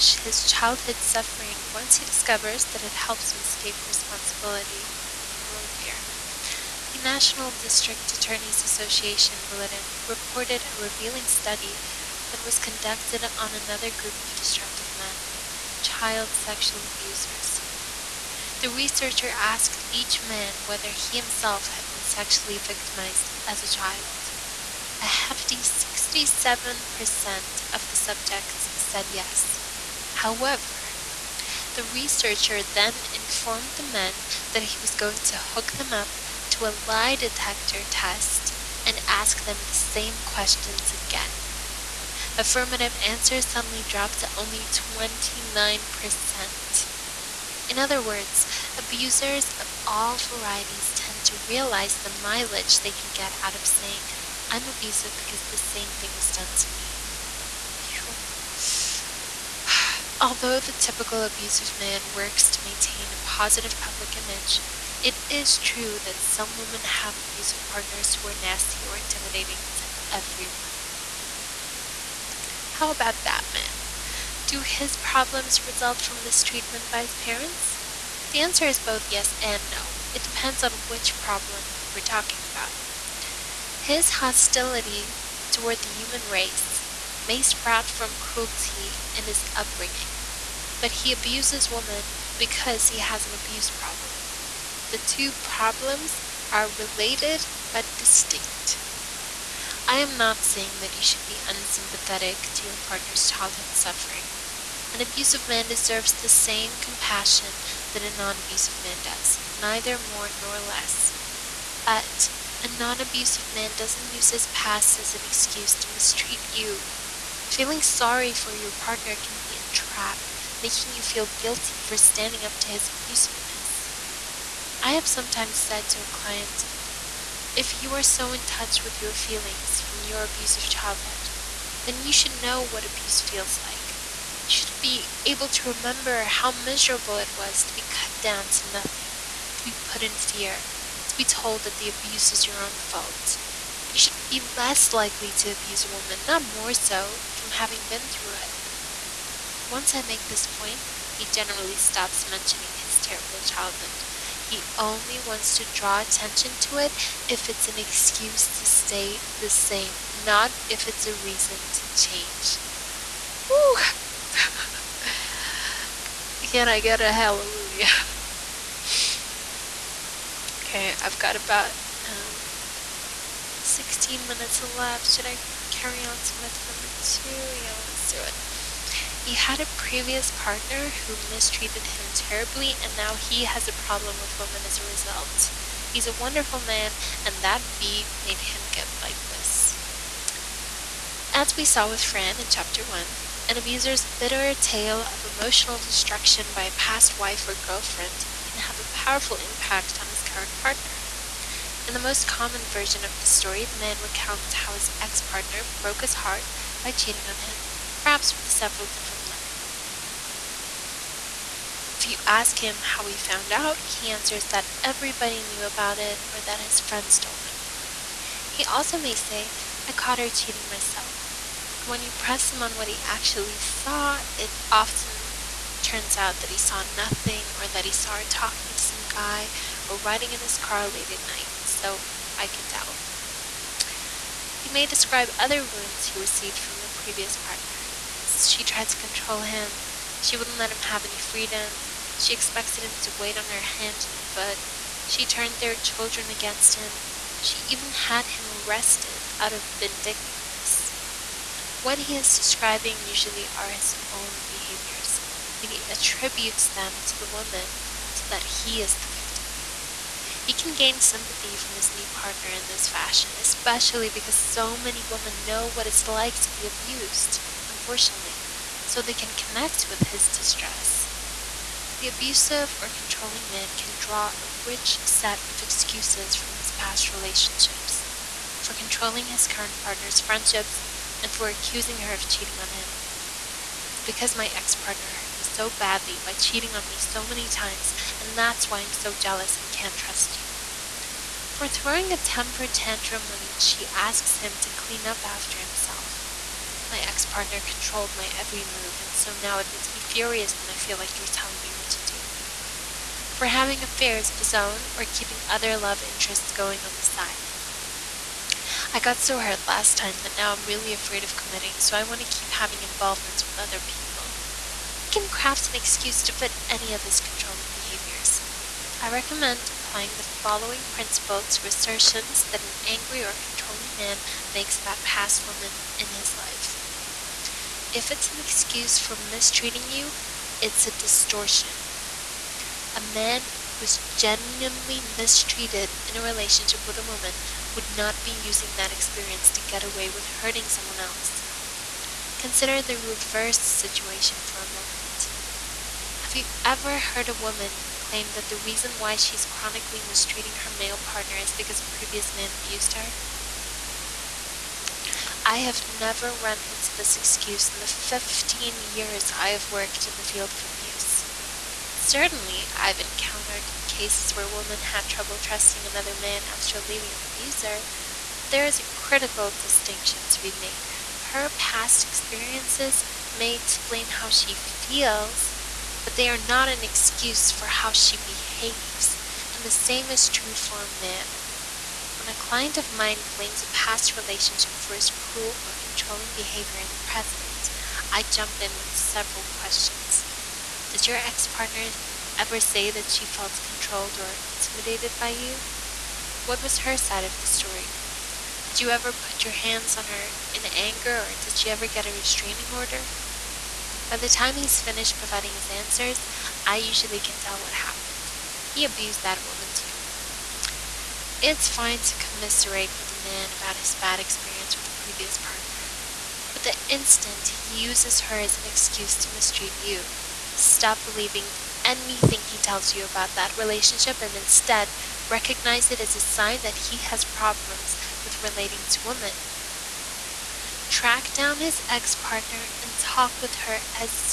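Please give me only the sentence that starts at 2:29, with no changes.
Once I make this point, he generally stops mentioning his terrible childhood.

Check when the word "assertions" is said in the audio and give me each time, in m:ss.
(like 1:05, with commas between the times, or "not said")
5:21.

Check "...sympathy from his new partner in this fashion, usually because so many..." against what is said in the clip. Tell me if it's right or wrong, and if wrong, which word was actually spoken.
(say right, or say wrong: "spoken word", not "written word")
wrong: "especially", not "usually".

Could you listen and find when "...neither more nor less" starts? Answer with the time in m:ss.
1:49.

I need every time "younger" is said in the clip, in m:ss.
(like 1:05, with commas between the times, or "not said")
not said.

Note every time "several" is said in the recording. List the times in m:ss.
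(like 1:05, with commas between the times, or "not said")
3:28, 6:28.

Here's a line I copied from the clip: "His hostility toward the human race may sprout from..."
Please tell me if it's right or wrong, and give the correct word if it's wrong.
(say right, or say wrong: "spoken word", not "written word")
right.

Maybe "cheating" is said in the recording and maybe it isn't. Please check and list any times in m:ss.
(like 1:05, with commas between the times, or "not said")
3:26, 3:40, 4:42, 4:46.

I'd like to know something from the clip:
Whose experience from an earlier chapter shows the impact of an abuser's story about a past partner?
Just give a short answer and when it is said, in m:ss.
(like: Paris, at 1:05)
Fran, at 3:12.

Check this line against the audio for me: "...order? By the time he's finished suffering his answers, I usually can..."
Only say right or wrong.
wrong.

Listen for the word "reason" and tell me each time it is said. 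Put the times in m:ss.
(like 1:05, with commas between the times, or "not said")
2:41, 5:48.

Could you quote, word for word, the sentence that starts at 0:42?
Affirmative answers suddenly dropped to only 29%.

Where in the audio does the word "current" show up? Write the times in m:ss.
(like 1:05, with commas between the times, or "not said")
3:20, 4:39.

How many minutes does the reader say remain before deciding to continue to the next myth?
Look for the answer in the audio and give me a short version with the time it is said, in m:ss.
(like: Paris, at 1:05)
16, at 2:53.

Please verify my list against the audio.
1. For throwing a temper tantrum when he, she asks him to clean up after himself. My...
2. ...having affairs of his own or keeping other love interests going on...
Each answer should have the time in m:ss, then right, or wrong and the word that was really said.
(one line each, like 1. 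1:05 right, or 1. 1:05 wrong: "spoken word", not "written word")
1. 4:51 right
2. 5:03 right.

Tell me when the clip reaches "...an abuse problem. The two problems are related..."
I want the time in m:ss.
1:33.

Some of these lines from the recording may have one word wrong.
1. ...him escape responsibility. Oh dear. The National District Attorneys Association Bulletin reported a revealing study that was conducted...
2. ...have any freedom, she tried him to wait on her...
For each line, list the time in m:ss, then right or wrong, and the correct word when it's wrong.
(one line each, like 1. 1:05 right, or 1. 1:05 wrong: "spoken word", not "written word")
1. 0:03 right
2. 4:00 wrong: "expected", not "tried".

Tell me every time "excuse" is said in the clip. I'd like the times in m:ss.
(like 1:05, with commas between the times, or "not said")
1:55, 2:37, 4:35, 5:15, 5:28, 5:57, 6:16, 6:58.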